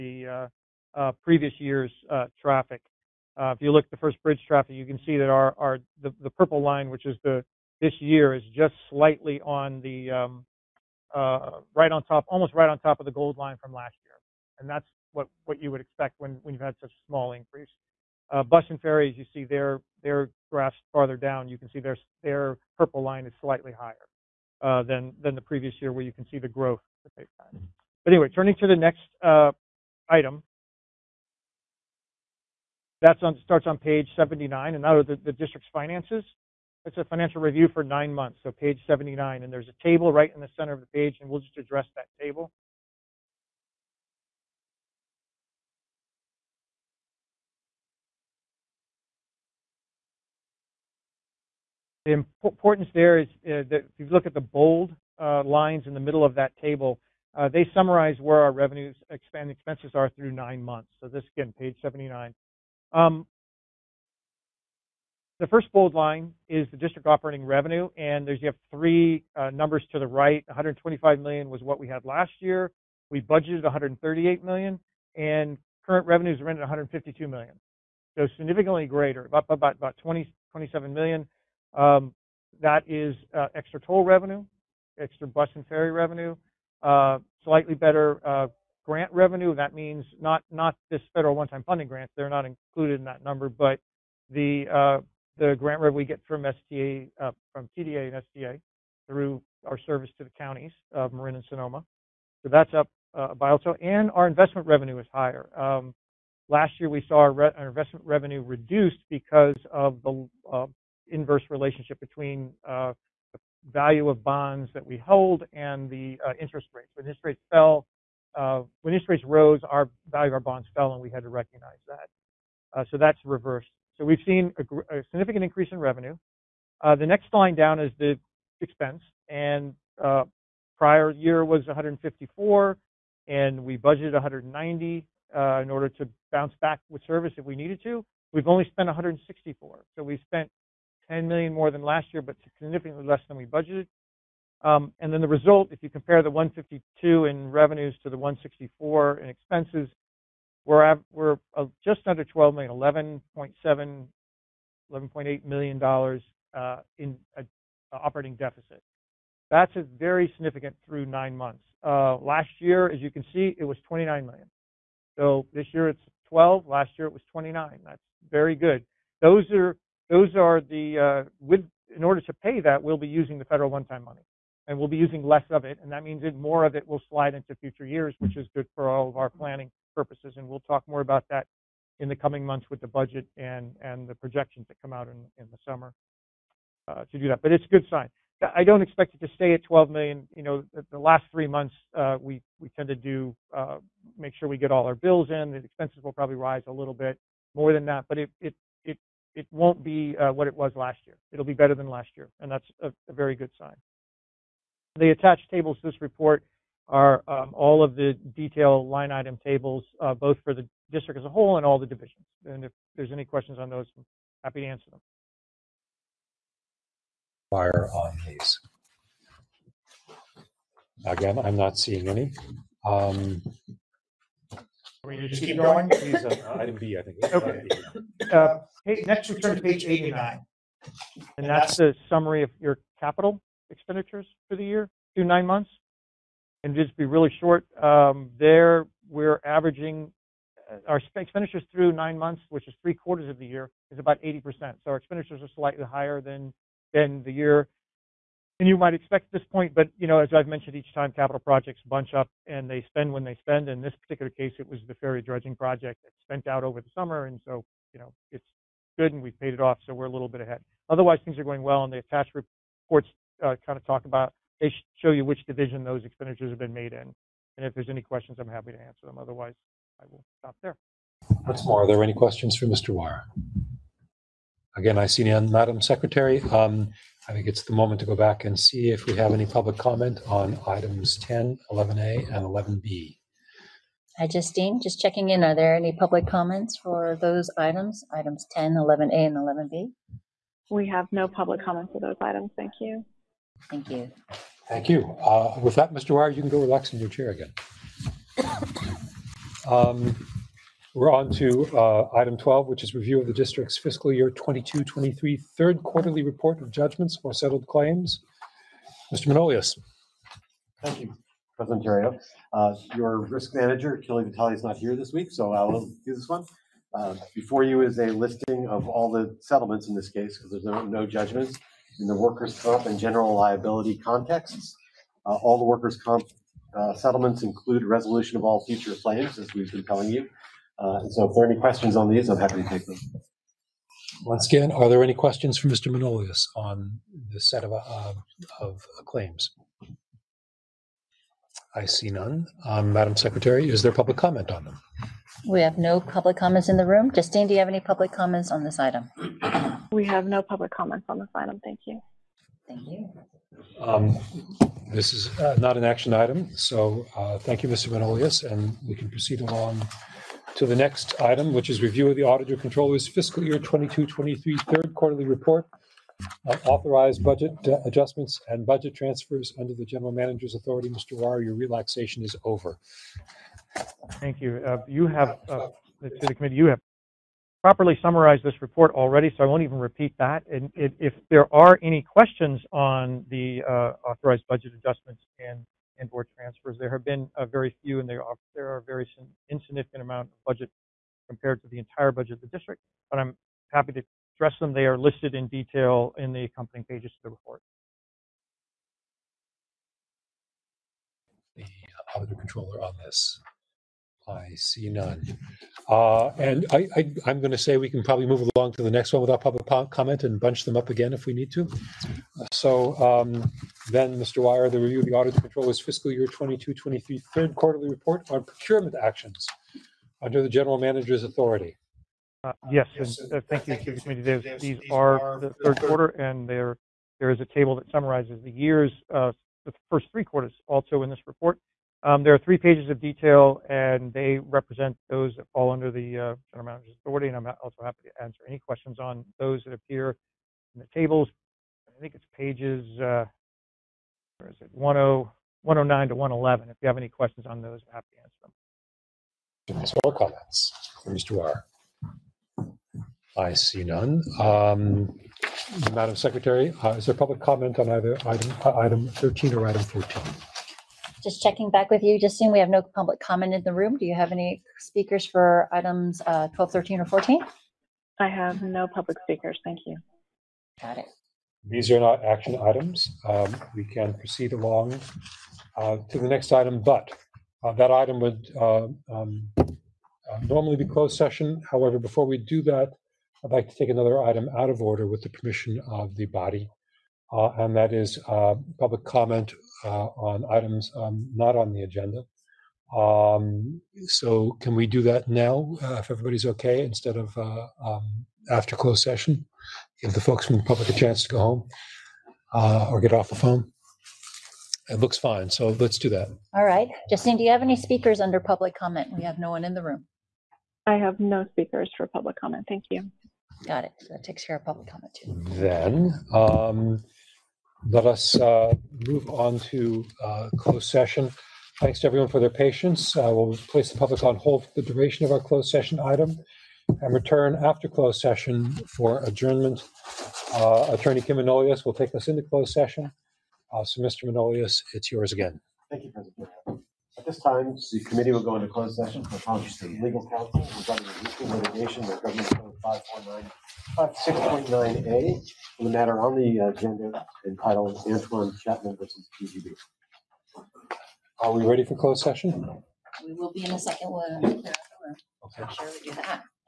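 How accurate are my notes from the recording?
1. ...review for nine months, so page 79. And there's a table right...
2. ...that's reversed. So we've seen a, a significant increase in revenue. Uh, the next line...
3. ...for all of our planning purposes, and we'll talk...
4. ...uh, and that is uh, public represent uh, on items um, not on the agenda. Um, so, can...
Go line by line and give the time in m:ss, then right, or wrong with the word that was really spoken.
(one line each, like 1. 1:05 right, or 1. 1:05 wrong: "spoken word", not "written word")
1. 0:37 right
2. 2:02 right
3. 2:58 right
4. 8:07 wrong: "comment", not "represent".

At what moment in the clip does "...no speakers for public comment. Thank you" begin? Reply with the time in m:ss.
8:31.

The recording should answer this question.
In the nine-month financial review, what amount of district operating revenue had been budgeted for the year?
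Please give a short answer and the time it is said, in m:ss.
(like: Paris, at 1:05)
138 million, at 1:13.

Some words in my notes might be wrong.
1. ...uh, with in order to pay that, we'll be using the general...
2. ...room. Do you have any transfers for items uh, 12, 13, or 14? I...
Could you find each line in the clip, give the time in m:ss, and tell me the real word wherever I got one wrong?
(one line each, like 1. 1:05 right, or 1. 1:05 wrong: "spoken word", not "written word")
1. 2:51 wrong: "federal", not "general"
2. 7:43 wrong: "speakers", not "transfers".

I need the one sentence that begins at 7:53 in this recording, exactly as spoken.
Um, we can proceed along uh, to the next item, but uh, that item would uh, um, uh, normally be closed session.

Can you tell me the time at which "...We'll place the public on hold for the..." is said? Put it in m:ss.
8:43.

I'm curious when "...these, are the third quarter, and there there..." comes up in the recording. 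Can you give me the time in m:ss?
7:04.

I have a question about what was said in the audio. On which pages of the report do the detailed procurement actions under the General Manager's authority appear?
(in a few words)
109 to 111.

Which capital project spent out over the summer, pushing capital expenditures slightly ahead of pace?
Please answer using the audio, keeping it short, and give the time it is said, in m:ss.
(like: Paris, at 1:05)
ferry dredging project, at 4:14.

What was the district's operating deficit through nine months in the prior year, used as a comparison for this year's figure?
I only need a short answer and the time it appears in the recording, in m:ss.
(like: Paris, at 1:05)
29 million, at 2:43.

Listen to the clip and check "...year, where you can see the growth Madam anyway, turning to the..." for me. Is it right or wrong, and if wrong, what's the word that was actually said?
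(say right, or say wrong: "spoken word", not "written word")
wrong: "But", not "Madam".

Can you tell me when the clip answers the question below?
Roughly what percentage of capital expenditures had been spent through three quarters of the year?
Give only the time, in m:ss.
4:04.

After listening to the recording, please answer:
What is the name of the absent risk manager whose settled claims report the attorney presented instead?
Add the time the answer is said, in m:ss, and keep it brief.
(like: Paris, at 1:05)
Kelly Vitale, at 5:13.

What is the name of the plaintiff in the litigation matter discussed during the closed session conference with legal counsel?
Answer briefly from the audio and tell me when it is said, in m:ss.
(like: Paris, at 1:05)
Antoine Chapman, at 9:08.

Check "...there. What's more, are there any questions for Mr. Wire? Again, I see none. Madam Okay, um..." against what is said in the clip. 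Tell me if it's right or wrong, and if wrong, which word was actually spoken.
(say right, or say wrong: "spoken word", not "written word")
wrong: "Secretary", not "Okay".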